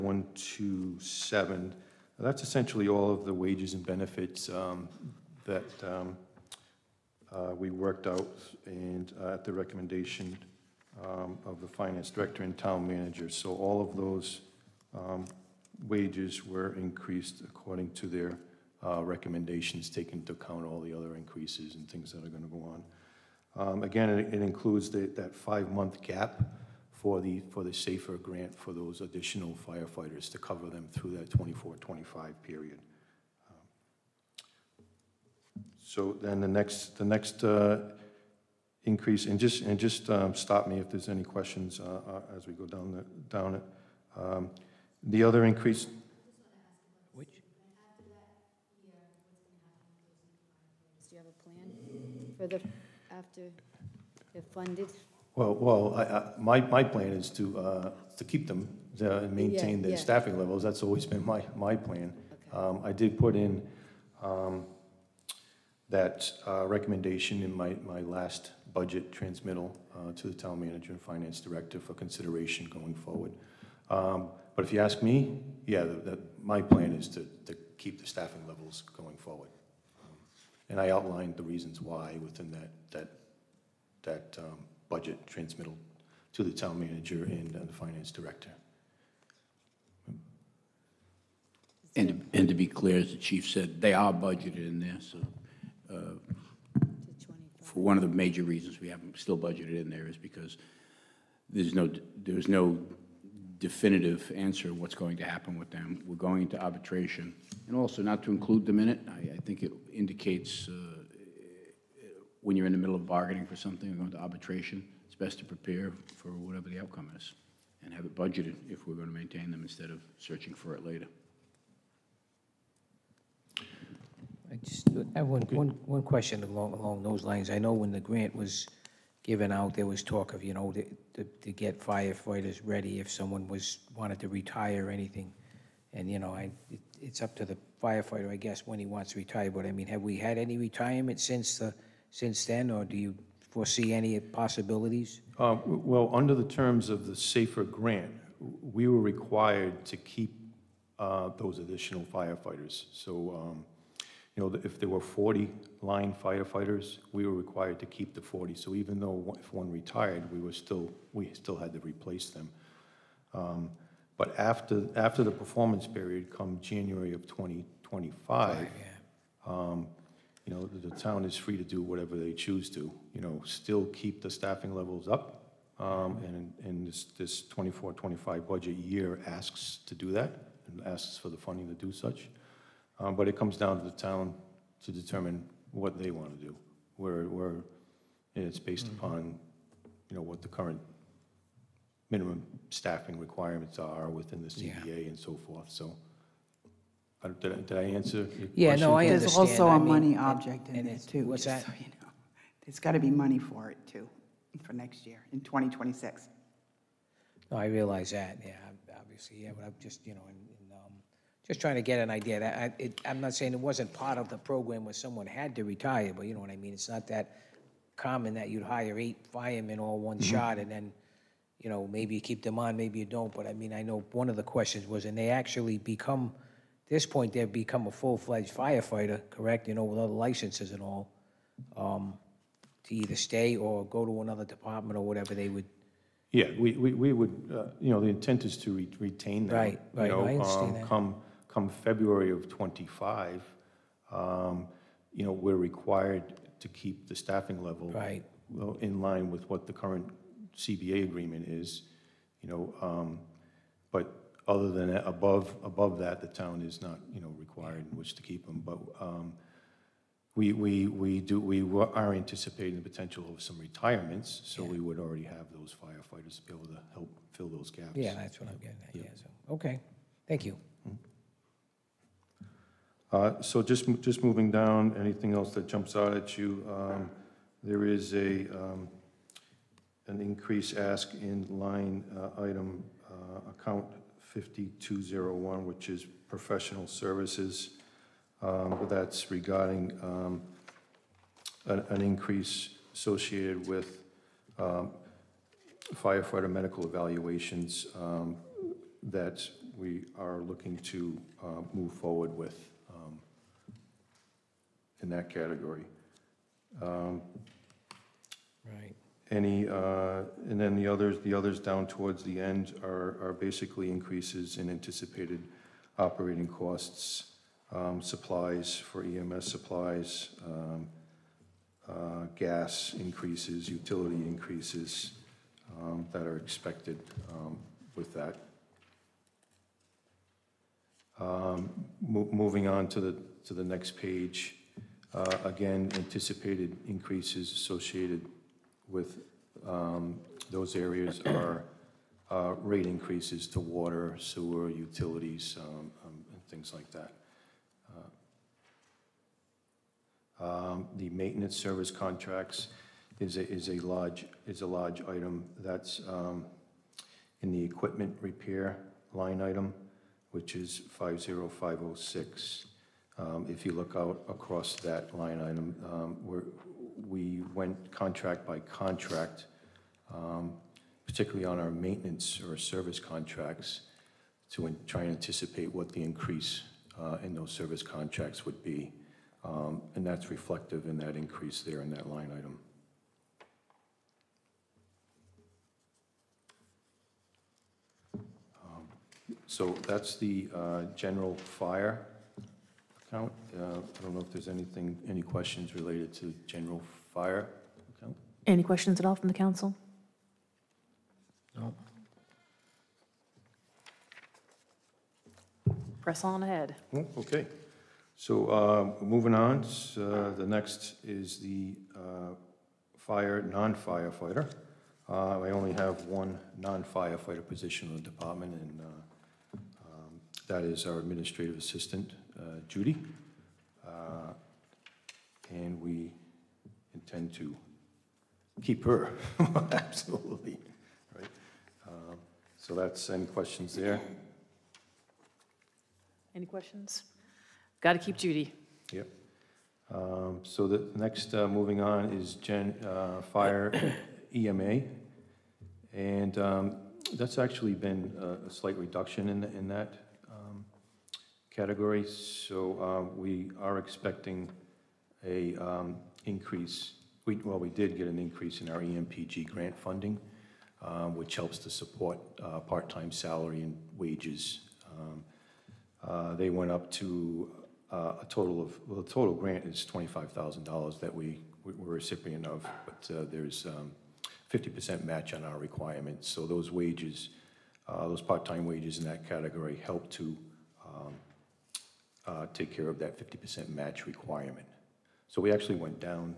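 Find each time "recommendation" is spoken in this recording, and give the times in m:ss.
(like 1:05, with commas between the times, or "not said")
0:09, 0:19, 1:06.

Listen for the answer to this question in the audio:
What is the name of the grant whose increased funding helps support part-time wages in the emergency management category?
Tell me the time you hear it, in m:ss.
7:38.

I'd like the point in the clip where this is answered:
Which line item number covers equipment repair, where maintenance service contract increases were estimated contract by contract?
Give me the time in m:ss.
6:00.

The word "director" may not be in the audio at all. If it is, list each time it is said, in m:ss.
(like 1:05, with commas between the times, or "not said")
0:12, 1:11, 1:28.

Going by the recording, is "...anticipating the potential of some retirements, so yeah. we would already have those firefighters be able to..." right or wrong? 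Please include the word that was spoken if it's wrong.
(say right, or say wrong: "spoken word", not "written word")
right.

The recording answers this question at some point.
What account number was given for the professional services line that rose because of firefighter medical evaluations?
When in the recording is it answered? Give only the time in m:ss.
4:44.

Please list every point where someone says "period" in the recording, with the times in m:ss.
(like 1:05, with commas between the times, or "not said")
0:32, 2:45.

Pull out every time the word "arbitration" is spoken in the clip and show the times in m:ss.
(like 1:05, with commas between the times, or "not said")
1:46, 1:54.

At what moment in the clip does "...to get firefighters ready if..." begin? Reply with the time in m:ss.
2:11.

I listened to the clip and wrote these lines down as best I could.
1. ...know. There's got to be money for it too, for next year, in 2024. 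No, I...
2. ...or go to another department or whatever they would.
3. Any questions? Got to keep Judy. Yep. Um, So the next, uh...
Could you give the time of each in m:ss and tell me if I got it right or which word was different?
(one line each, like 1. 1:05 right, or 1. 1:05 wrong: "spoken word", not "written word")
1. 3:21 wrong: "2026", not "2024"
2. 3:53 right
3. 7:16 right.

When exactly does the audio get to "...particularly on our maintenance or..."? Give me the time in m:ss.
6:11.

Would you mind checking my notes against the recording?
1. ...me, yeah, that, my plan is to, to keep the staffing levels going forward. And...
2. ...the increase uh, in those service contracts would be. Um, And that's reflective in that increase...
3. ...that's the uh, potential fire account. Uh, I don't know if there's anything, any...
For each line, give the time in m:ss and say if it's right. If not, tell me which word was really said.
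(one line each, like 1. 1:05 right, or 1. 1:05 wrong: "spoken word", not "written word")
1. 1:15 right
2. 6:15 right
3. 6:29 wrong: "general", not "potential".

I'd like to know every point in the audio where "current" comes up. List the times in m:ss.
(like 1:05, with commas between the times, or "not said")
3:10, 4:09.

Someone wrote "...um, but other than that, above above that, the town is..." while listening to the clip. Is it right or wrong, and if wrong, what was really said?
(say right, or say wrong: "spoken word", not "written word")
right.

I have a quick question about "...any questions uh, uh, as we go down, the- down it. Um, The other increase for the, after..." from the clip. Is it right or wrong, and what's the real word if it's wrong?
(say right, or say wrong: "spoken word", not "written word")
right.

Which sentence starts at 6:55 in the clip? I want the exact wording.
Uh, I only have one non-firefighter position in the department, and uh, um, that is our administrative assistant.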